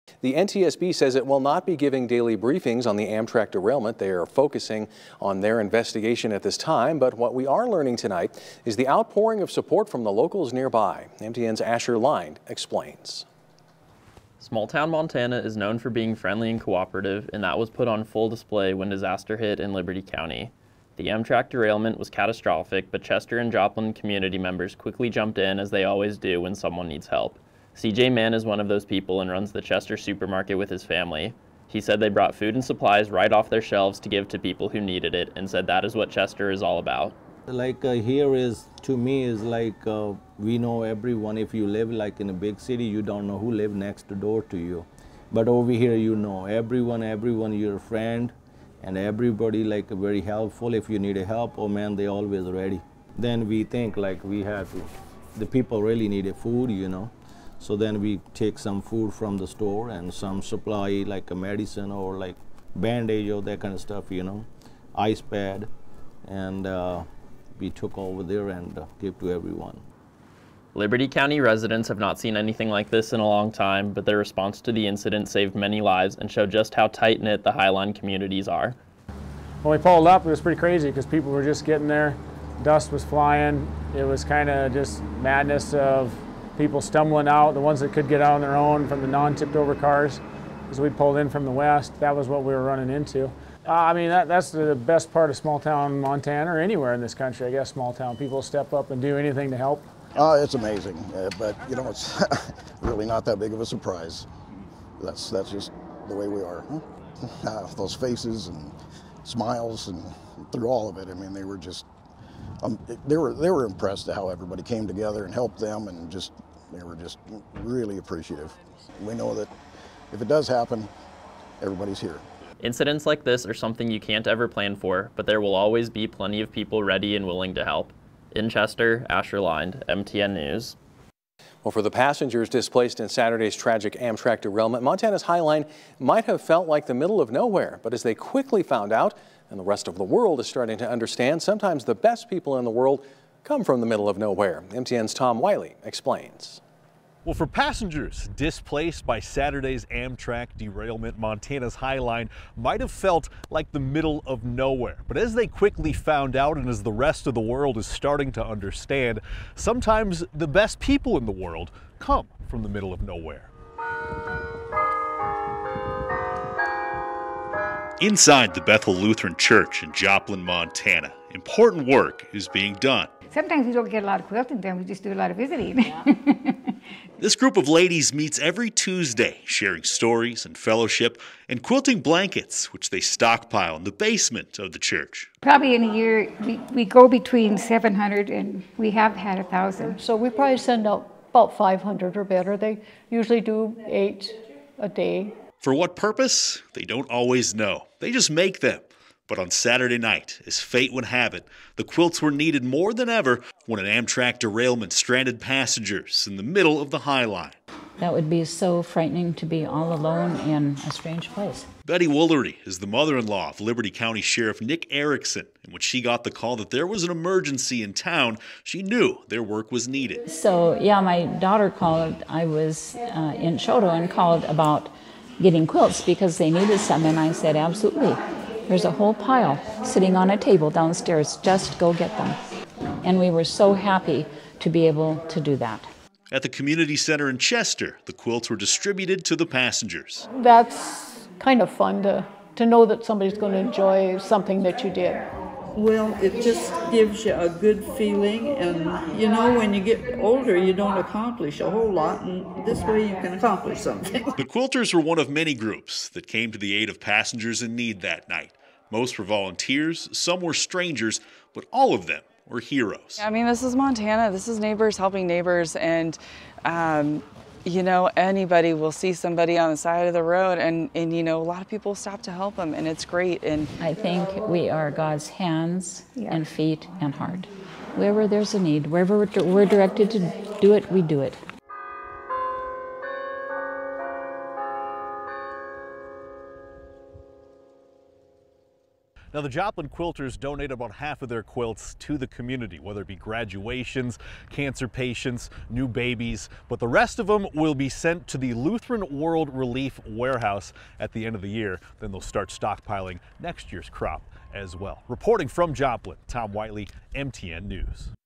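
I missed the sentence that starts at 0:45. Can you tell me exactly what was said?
But over here, you know everyone, everyone, your friend, and everybody like very helpful.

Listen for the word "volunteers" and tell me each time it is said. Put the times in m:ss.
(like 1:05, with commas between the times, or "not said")
4:19.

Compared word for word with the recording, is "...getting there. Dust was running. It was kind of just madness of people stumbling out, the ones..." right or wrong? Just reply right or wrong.
wrong.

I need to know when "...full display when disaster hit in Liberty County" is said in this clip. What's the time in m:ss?
0:18.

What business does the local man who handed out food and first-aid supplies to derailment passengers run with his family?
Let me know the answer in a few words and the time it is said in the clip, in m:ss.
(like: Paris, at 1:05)
Chester supermarket, at 0:29.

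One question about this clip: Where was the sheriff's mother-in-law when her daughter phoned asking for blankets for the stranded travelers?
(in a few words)
Choteau.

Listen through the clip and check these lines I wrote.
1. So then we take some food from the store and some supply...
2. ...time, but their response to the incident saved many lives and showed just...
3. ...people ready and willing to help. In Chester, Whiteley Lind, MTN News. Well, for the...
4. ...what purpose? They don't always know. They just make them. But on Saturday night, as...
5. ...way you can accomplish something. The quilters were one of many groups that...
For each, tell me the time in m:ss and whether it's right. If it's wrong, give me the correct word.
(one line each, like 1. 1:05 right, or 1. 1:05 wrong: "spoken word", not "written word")
1. 0:57 right
2. 1:13 right
3. 2:06 wrong: "Asher", not "Whiteley"
4. 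3:15 right
5. 4:12 right.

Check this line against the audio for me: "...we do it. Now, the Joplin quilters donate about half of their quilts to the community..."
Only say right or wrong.
right.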